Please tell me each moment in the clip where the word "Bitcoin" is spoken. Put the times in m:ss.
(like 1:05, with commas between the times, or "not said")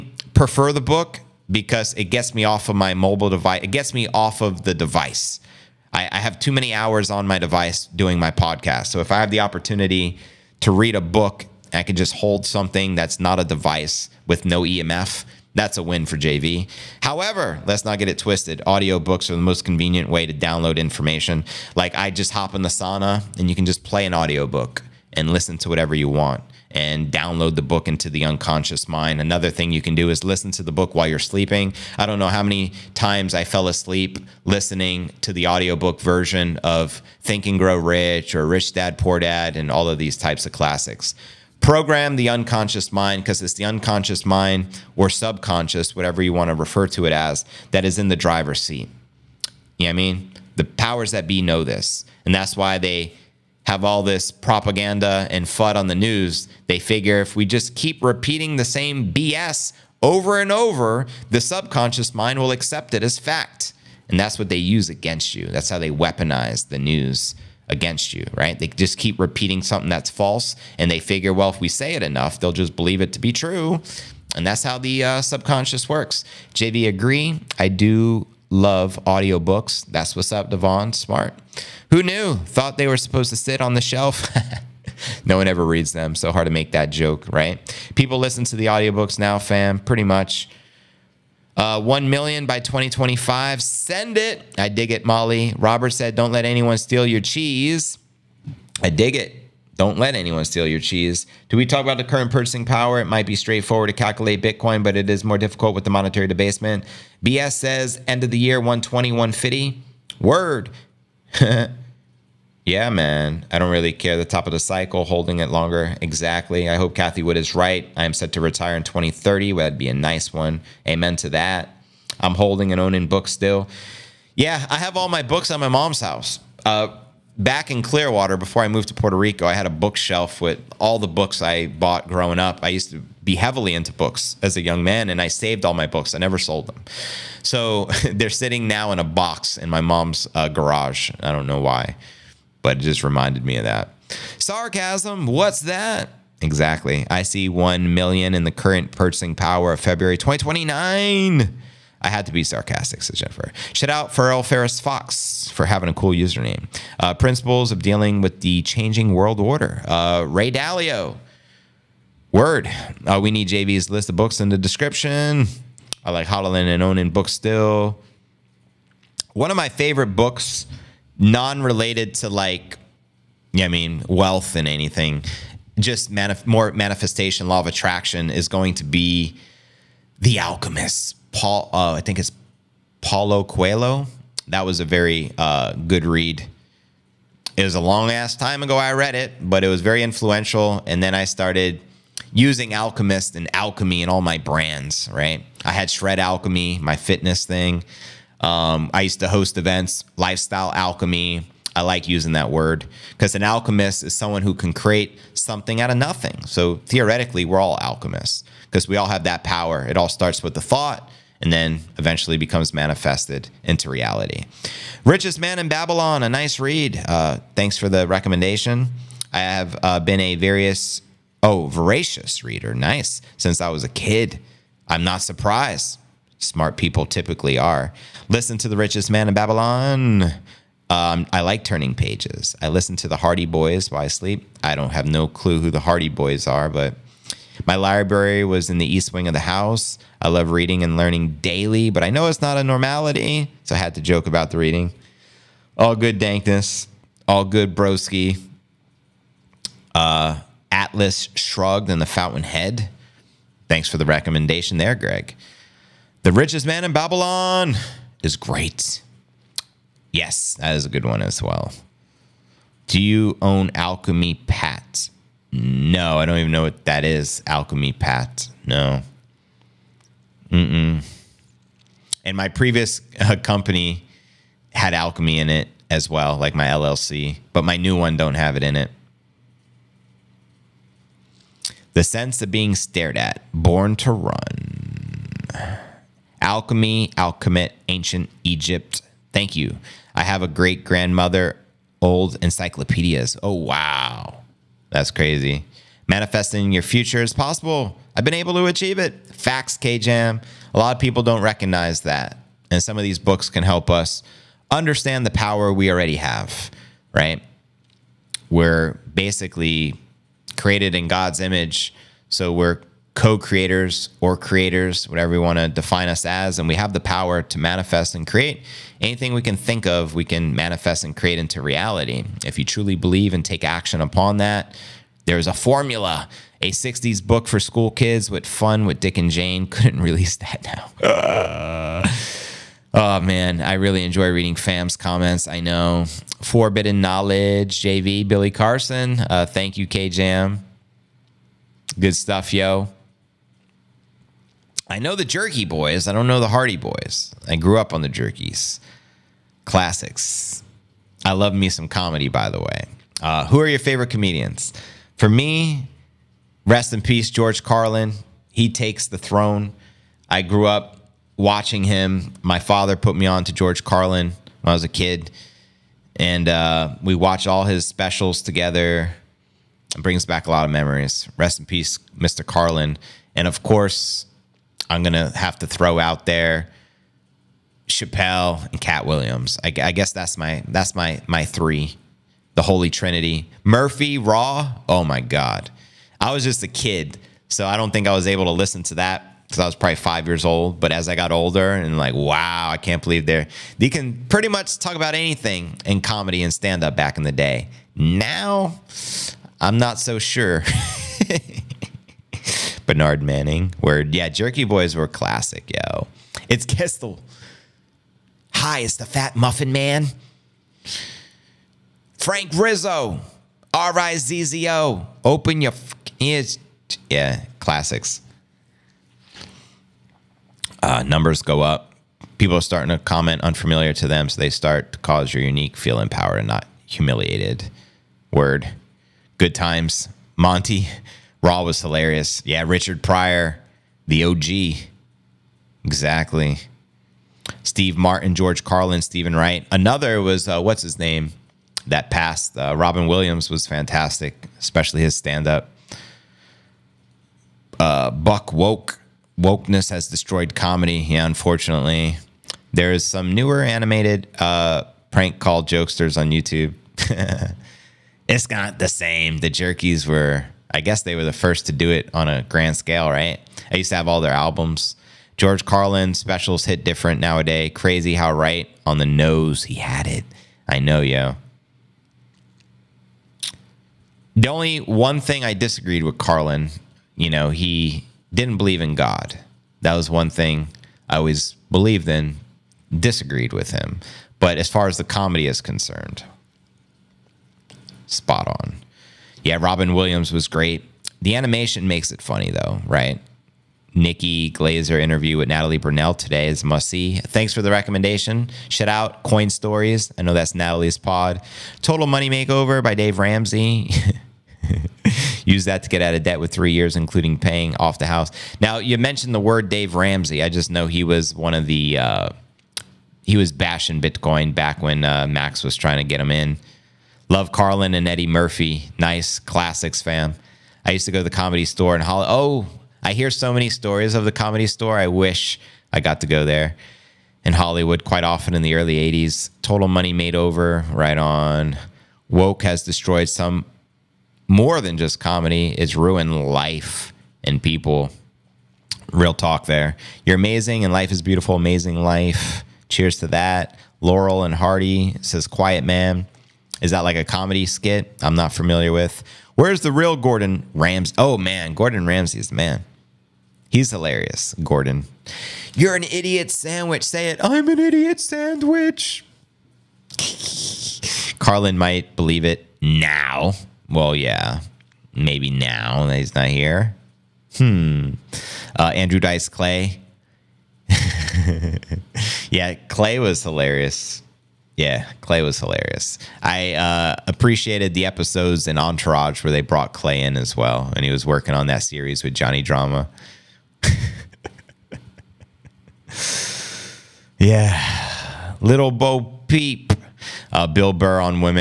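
1:44, 8:34.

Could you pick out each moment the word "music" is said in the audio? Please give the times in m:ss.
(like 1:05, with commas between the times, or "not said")
not said.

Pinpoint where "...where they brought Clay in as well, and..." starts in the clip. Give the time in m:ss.
9:39.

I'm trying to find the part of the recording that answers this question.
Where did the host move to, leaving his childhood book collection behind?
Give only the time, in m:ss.
2:08.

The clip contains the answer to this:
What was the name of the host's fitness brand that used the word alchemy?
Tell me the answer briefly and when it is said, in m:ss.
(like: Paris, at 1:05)
Shred Alchemy, at 3:15.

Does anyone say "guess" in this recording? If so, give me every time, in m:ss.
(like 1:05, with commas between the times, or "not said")
6:19, 7:40.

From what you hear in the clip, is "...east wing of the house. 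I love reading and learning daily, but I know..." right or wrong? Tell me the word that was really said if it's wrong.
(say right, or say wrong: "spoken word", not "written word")
right.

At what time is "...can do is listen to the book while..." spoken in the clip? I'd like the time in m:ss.
0:29.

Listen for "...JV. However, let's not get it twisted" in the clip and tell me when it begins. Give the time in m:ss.
0:16.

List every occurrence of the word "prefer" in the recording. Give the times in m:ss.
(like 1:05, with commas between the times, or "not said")
0:00.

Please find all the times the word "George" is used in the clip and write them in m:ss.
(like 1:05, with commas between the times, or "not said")
5:57, 6:03, 7:18, 7:45.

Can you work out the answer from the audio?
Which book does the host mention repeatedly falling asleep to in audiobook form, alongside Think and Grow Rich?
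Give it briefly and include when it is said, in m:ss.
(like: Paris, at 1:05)
Rich Dad Poor Dad, at 0:38.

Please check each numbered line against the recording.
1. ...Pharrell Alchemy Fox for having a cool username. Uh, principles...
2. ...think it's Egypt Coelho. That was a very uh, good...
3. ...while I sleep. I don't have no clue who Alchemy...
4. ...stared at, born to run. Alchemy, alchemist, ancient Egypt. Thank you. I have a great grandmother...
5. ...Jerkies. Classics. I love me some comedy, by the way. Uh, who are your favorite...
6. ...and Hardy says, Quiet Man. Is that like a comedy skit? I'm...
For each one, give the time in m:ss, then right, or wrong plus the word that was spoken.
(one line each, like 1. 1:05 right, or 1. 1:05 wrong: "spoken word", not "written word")
1. 2:34 wrong: "Ferris", not "Alchemy"
2. 3:02 wrong: "Paulo", not "Egypt"
3. 3:53 wrong: "The", not "Alchemy"
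4. 4:42 right
5. 5:48 right
6. 9:04 right.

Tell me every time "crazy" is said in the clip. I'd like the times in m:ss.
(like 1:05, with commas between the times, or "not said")
4:55, 7:47.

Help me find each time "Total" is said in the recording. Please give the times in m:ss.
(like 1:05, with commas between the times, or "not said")
8:21, 8:49.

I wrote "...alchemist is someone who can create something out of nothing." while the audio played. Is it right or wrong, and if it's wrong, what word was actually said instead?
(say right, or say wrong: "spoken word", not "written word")
right.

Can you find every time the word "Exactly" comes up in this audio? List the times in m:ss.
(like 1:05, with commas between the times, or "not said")
1:56, 2:26, 7:15.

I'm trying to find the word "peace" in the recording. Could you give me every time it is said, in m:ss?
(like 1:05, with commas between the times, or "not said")
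5:57, 6:11.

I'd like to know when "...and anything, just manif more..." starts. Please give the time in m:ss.
2:54.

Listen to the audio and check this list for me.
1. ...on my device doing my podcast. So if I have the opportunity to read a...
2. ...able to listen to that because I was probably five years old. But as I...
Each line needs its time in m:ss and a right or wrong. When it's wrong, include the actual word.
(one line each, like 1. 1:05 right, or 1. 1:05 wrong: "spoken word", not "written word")
1. 0:07 right
2. 6:28 right.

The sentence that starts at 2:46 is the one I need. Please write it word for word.
I like Holland and owning books still.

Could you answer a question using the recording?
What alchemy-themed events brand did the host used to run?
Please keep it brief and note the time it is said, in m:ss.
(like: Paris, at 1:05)
Lifestyle Alchemy, at 3:20.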